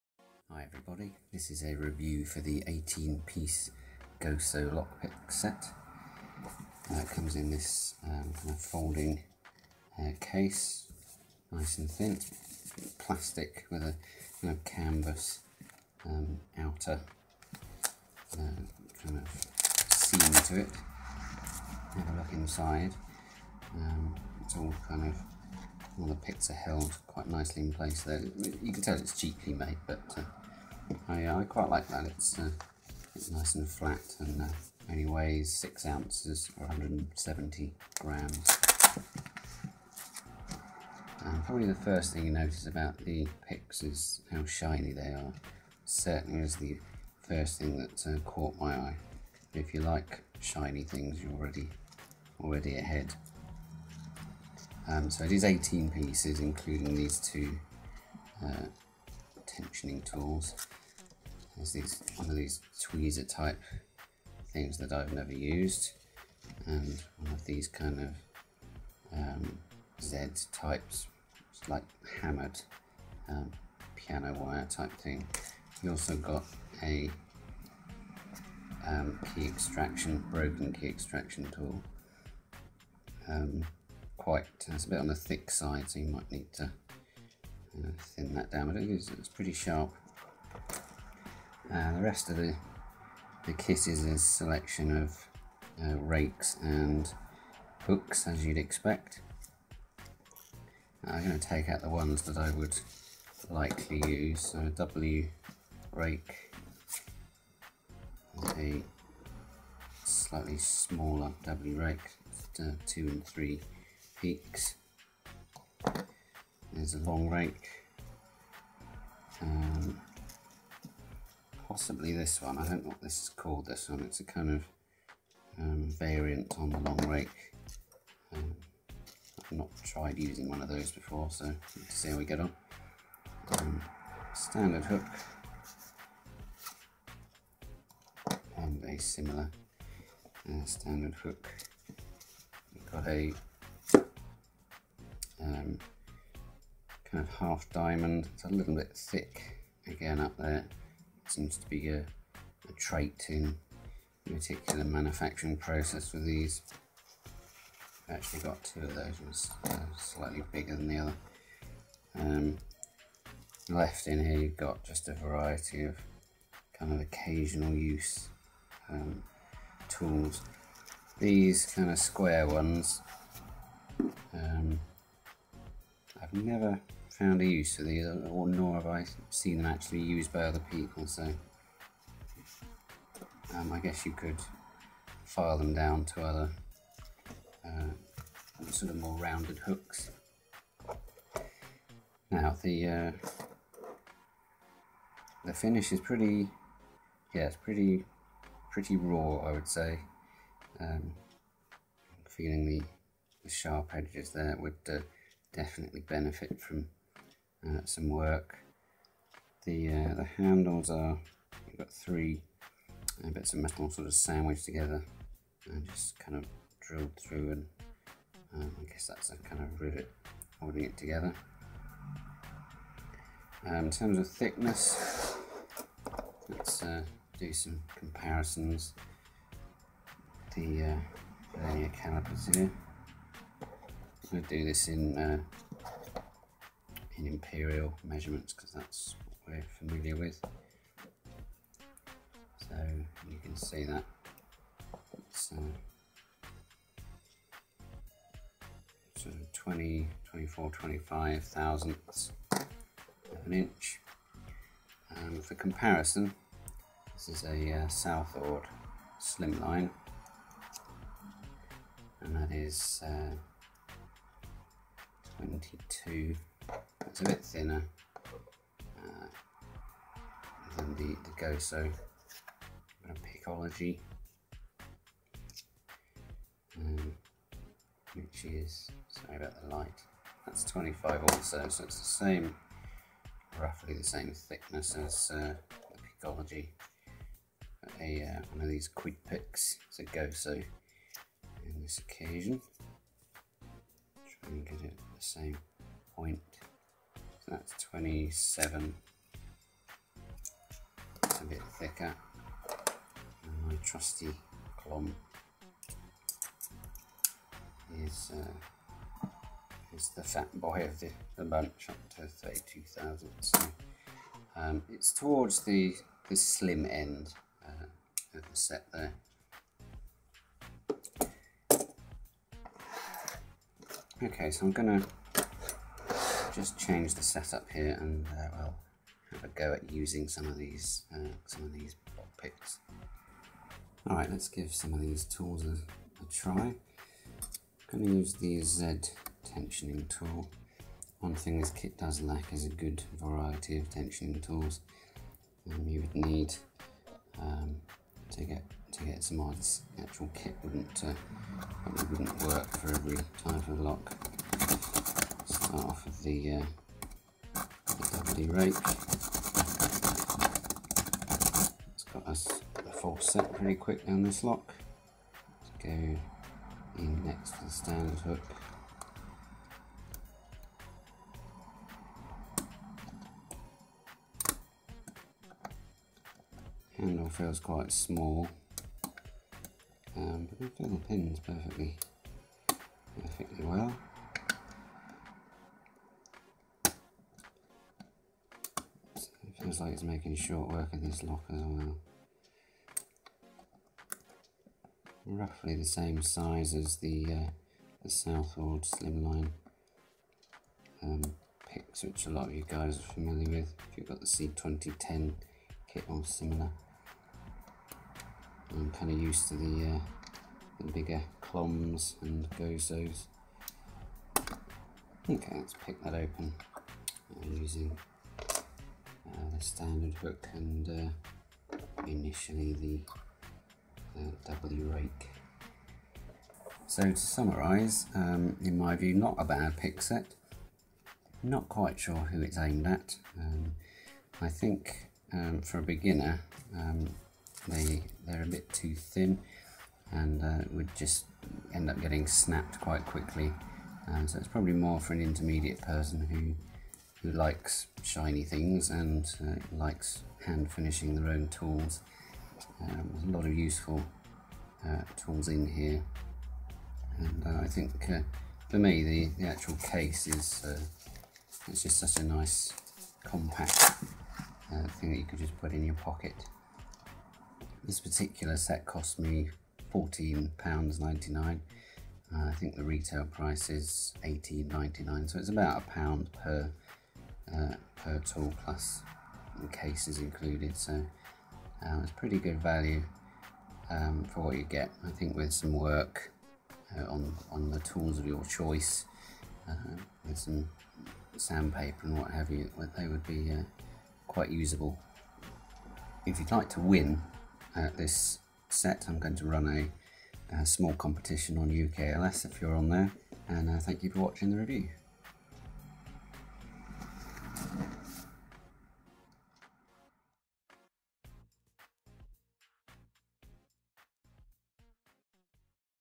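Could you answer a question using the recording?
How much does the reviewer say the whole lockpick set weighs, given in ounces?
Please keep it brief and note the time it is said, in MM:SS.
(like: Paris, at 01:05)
6 ounces, at 00:35.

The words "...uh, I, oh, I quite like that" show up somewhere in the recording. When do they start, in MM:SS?
00:30.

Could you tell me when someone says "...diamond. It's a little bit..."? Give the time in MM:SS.
02:27.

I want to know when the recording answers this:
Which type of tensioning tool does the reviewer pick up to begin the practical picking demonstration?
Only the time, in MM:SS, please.
05:38.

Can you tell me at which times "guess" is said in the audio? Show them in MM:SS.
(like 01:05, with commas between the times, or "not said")
03:03, 03:38.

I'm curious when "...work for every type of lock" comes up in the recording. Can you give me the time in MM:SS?
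05:52.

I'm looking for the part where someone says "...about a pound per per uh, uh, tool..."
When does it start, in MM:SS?
07:55.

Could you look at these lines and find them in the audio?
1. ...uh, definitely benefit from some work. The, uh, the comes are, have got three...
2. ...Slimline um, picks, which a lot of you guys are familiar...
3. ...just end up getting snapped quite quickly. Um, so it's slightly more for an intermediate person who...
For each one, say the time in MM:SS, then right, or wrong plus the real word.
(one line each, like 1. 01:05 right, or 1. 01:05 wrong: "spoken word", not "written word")
1. 03:24 wrong: "handles", not "comes"
2. 06:38 right
3. 07:20 wrong: "probably", not "slightly".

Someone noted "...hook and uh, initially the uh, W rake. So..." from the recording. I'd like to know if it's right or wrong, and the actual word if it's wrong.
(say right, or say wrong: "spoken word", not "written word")
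right.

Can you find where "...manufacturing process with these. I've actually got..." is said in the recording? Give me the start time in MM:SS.
02:34.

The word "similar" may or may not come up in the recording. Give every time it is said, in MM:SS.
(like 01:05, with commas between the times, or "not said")
02:19, 06:46.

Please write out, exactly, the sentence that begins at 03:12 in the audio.
Now the uh, the finish is pretty, yeah, it's pretty pretty raw, I would say.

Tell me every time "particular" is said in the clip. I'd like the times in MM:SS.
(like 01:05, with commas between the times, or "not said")
02:34, 07:47.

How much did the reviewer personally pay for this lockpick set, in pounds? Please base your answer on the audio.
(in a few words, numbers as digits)
£14.99.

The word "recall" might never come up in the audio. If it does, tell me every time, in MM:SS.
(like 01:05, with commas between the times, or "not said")
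not said.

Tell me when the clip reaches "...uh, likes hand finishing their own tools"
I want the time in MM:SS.
07:29.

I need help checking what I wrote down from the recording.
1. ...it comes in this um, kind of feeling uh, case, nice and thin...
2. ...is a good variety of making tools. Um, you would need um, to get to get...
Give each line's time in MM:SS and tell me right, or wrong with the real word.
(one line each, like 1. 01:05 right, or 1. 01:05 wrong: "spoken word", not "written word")
1. 00:06 wrong: "folding", not "feeling"
2. 05:42 wrong: "tensioning", not "making".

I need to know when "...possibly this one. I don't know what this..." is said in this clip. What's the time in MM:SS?
02:01.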